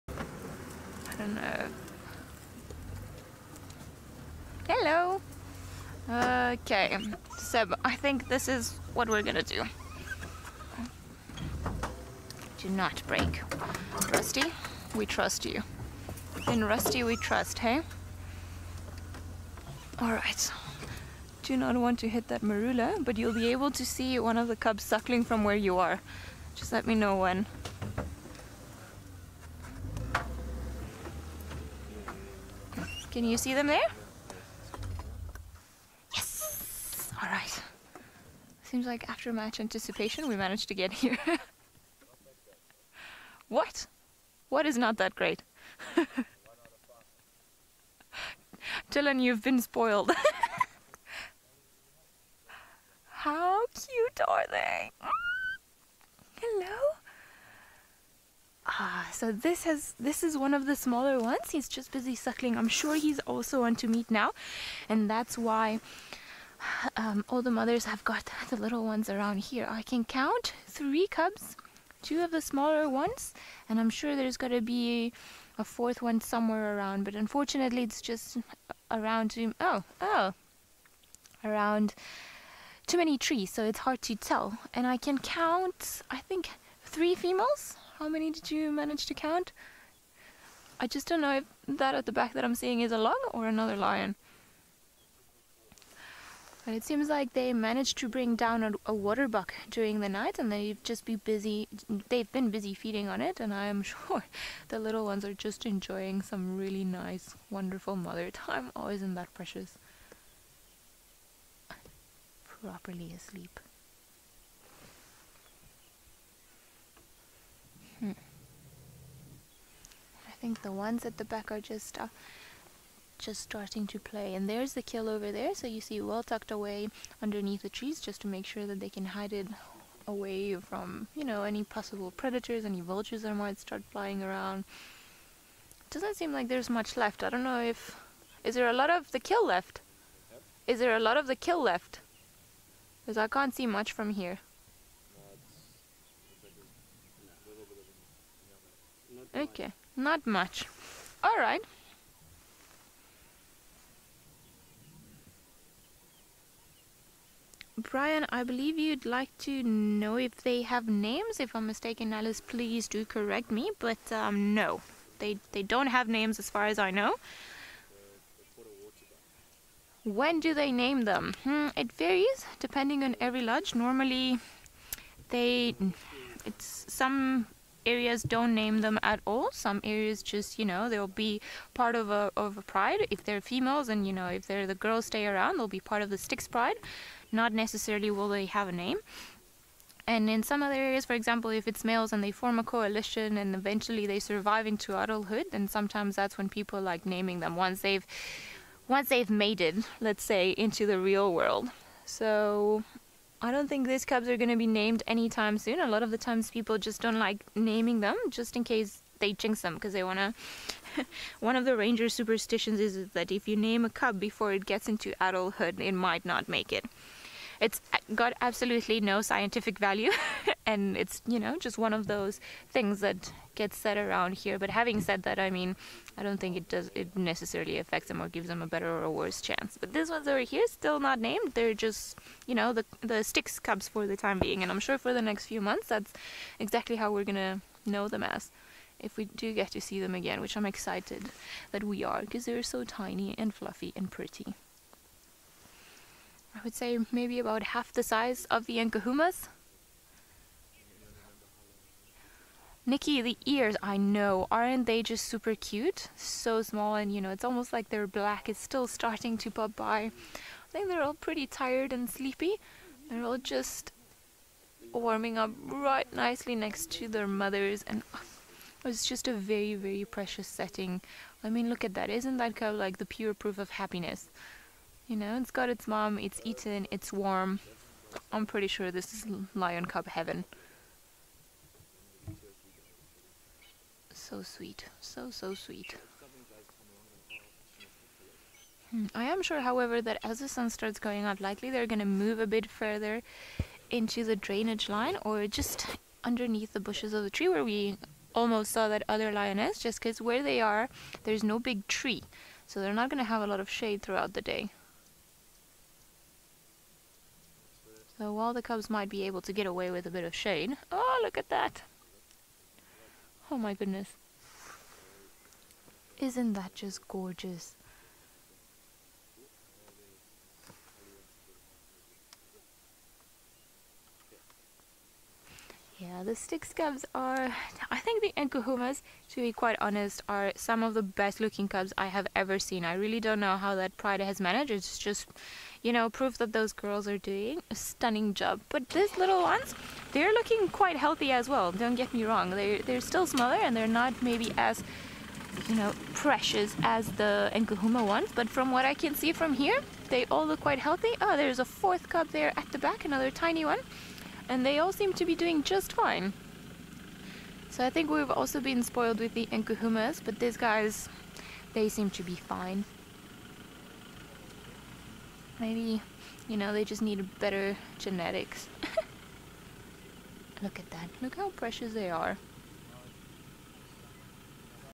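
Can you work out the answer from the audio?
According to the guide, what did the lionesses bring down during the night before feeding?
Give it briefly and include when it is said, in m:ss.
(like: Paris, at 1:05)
a buck, at 1:38.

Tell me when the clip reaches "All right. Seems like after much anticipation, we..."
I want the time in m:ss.
0:37.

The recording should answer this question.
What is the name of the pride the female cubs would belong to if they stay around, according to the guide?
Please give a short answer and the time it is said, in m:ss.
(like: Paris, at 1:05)
Styx pride, at 3:06.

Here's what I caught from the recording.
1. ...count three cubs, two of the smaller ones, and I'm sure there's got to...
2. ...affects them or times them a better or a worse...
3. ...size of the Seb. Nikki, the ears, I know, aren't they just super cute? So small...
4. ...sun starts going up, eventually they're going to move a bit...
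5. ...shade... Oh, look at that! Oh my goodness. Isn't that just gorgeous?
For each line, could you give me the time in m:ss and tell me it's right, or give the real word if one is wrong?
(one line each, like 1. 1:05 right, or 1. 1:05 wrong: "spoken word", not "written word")
1. 1:10 right
2. 3:47 wrong: "gives", not "times"
3. 4:08 wrong: "Nkuhumas", not "Seb"
4. 4:50 wrong: "likely", not "eventually"
5. 5:10 right.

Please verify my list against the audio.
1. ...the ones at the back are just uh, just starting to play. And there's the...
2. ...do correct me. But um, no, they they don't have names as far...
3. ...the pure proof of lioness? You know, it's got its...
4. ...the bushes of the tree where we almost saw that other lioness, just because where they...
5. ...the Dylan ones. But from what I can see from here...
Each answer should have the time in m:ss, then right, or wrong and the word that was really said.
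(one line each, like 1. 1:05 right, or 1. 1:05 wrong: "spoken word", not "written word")
1. 2:00 right
2. 2:42 right
3. 4:32 wrong: "happiness", not "lioness"
4. 4:56 right
5. 5:47 wrong: "Nkuhuma", not "Dylan".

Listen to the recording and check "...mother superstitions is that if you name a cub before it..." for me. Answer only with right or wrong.
wrong.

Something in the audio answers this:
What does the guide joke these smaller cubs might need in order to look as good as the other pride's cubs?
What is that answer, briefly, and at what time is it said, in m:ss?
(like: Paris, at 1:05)
better genetics, at 6:07.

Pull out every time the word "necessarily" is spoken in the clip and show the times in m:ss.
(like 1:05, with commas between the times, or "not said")
3:07, 3:47.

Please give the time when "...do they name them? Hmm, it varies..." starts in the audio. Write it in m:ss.
2:50.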